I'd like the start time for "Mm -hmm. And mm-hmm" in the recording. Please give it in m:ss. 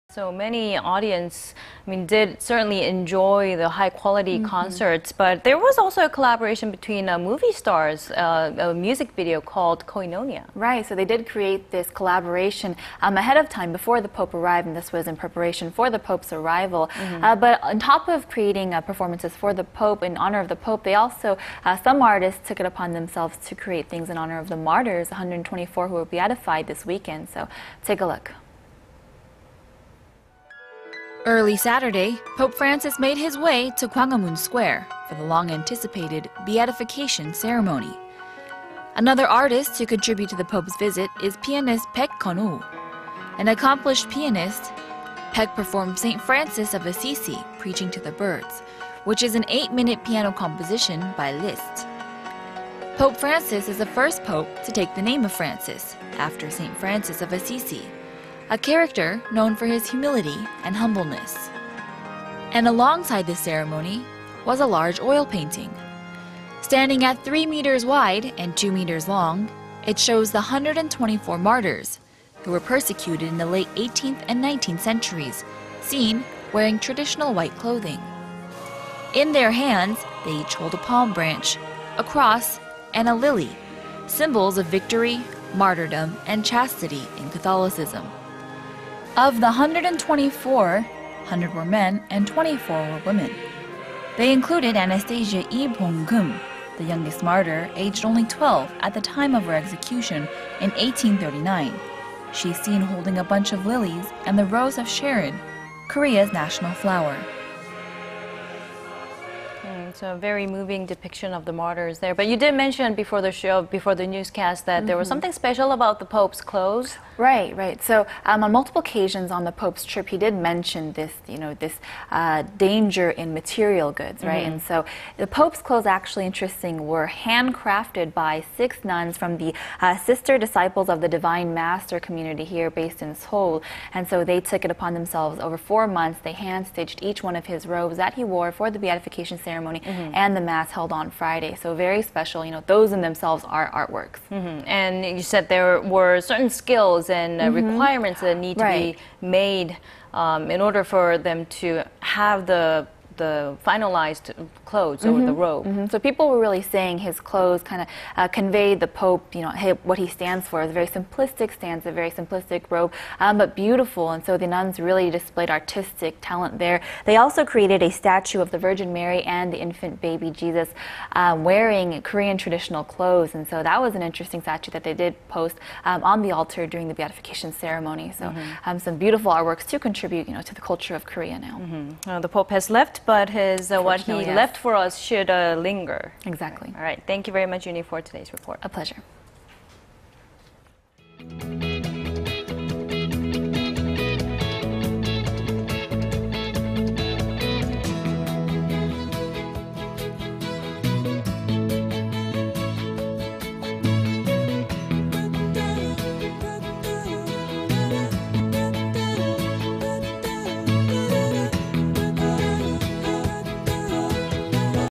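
2:04.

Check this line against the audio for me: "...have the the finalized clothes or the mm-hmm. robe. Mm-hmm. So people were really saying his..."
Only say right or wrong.
right.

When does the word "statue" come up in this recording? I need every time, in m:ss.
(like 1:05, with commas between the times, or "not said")
2:47, 2:54.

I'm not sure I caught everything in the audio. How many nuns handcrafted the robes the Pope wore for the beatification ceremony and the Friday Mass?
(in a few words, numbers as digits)
6.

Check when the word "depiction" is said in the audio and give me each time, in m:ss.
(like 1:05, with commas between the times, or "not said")
1:50.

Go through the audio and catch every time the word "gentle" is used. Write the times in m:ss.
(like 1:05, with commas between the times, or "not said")
not said.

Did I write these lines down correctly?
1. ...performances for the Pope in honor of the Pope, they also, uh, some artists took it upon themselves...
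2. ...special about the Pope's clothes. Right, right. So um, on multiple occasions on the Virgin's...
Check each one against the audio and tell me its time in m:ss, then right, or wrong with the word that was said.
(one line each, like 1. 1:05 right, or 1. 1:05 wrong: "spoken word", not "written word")
1. 0:18 right
2. 1:55 wrong: "Pope", not "Virgin".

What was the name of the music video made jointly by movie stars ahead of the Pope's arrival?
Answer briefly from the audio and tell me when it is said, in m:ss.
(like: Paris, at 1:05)
Koinonia, at 0:09.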